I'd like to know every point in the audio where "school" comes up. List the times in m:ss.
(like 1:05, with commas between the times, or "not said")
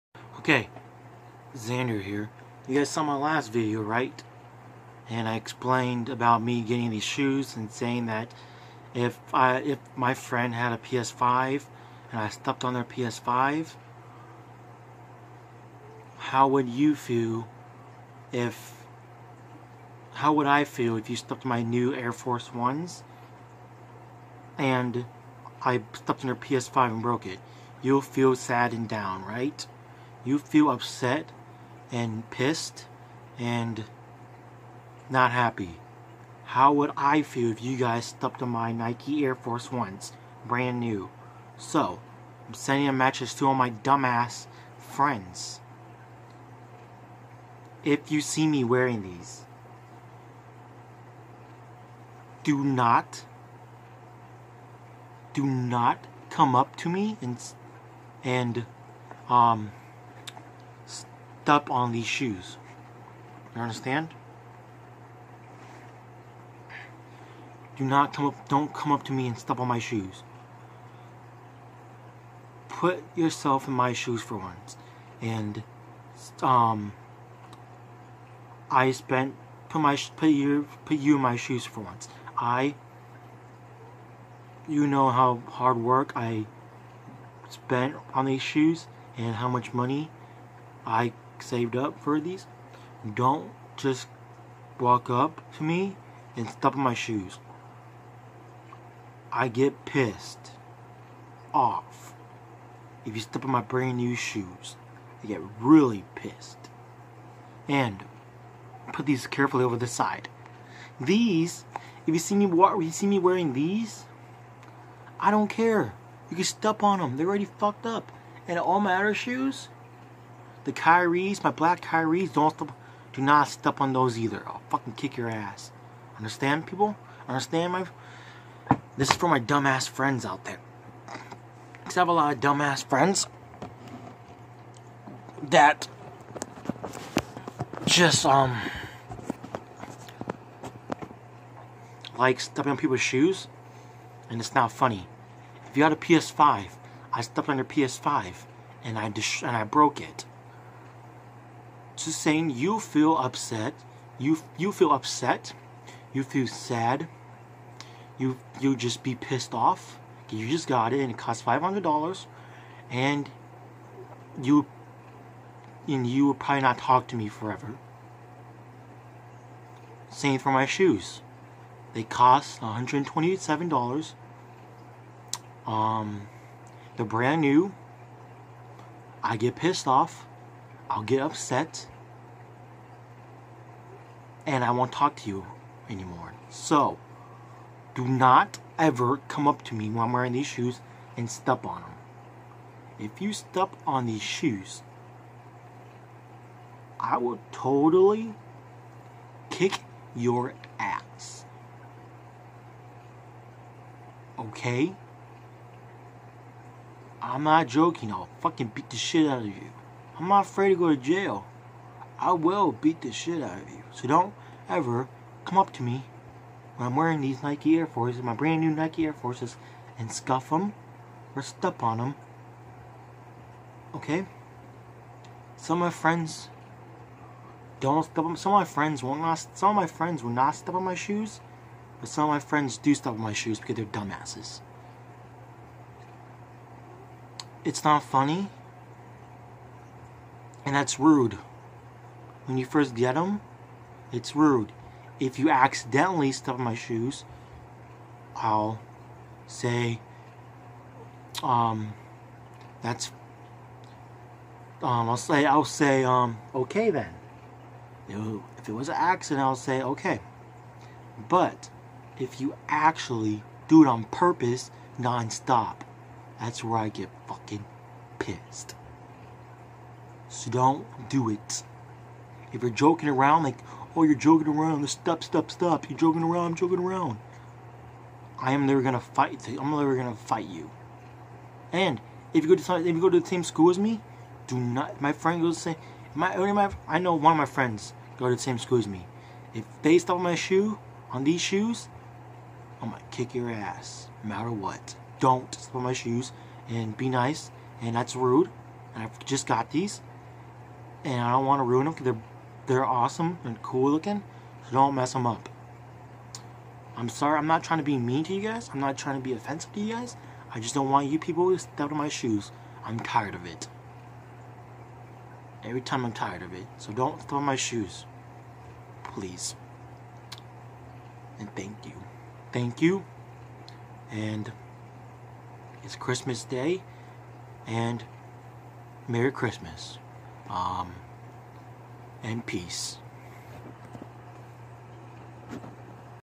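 4:43, 4:48.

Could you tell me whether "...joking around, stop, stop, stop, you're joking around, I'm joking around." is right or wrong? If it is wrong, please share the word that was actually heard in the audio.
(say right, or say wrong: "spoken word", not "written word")
right.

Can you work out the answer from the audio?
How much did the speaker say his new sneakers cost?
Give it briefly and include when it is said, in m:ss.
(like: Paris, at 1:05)
$127, at 2:52.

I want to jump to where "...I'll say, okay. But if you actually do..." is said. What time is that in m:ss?
4:19.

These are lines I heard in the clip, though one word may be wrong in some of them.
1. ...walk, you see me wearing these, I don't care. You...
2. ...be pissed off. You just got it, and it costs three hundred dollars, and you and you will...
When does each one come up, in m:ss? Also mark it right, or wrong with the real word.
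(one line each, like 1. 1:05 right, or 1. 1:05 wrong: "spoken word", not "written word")
1. 1:52 right
2. 2:39 wrong: "five", not "three".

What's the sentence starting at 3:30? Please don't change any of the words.
I'm not afraid to go to jail.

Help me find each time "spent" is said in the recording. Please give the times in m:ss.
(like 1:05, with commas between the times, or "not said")
1:18, 1:27.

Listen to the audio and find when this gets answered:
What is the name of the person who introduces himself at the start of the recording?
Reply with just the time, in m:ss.
0:01.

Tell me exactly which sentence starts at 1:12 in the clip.
Put yourself in my shoes for once.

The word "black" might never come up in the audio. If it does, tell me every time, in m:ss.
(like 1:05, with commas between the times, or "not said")
2:01.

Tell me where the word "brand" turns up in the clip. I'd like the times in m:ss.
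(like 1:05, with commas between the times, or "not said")
0:40, 1:43, 2:57, 3:38.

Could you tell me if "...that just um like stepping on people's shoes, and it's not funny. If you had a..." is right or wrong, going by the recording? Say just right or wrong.
right.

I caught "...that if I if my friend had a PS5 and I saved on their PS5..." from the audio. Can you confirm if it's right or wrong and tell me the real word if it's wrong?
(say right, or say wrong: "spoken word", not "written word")
wrong: "stepped", not "saved".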